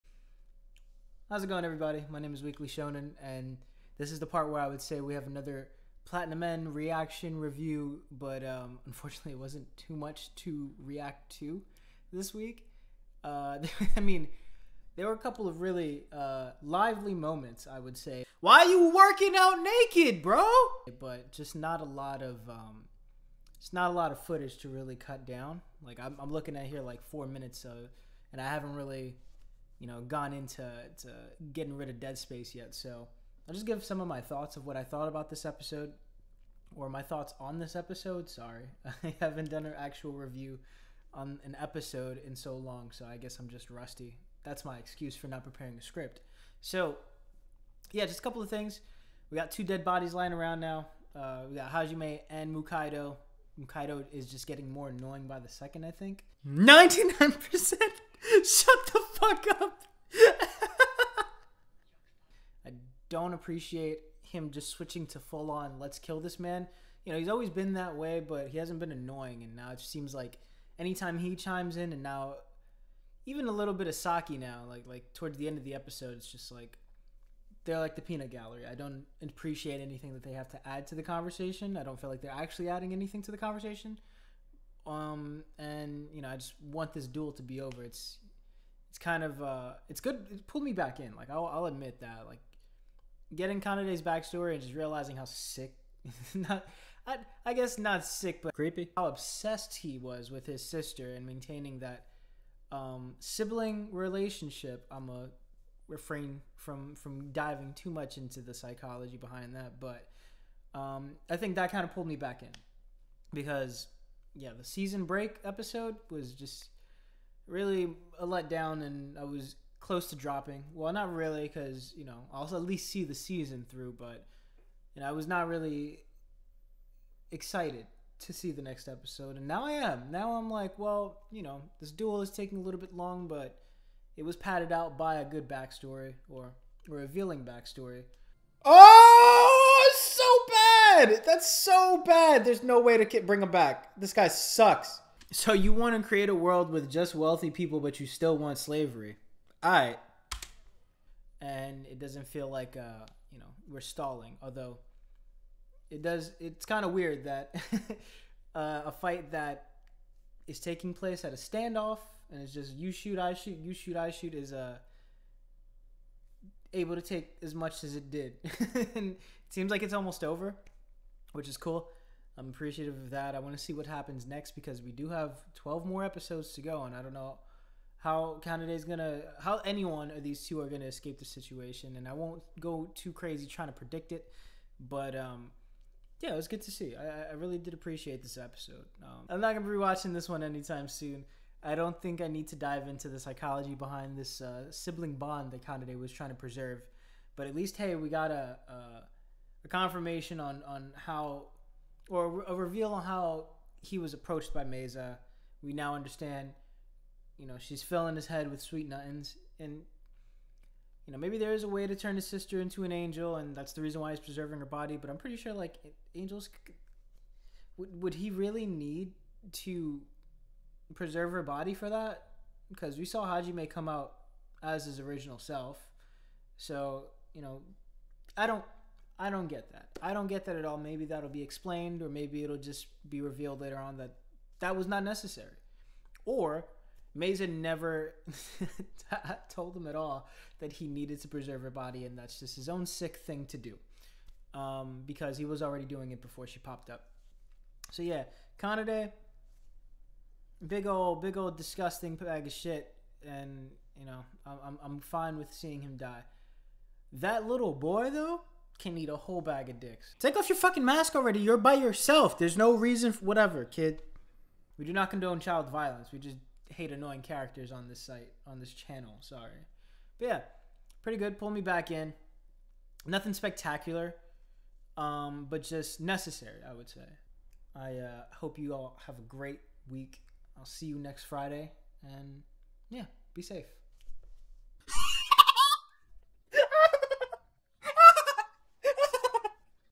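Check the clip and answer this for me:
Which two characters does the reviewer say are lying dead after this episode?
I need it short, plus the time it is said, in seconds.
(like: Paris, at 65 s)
Hajime and Mukaido, at 51 s.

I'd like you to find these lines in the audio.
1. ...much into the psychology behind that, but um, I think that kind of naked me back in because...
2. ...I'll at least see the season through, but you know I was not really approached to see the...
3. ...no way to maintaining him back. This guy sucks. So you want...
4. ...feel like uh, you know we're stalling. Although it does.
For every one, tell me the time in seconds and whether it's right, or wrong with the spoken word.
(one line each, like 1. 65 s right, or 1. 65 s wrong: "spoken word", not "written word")
1. 107 s wrong: "pulled", not "naked"
2. 122 s wrong: "excited", not "approached"
3. 142 s wrong: "bring", not "maintaining"
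4. 152 s right.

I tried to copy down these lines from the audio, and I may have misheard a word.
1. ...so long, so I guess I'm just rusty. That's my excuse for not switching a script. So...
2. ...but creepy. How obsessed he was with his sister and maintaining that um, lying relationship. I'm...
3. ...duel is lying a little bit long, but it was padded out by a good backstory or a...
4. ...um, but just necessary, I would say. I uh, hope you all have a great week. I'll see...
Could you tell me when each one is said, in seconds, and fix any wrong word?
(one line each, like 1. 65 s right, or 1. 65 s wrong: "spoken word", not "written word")
1. 42 s wrong: "preparing", not "switching"
2. 98 s wrong: "sibling", not "lying"
3. 131 s wrong: "taking", not "lying"
4. 274 s right.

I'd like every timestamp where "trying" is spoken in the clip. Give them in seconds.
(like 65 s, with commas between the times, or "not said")
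183 s, 196 s.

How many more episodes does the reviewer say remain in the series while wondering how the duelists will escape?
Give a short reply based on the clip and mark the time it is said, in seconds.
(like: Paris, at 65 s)
12, at 175 s.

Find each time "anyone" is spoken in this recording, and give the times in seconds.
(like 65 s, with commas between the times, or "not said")
179 s.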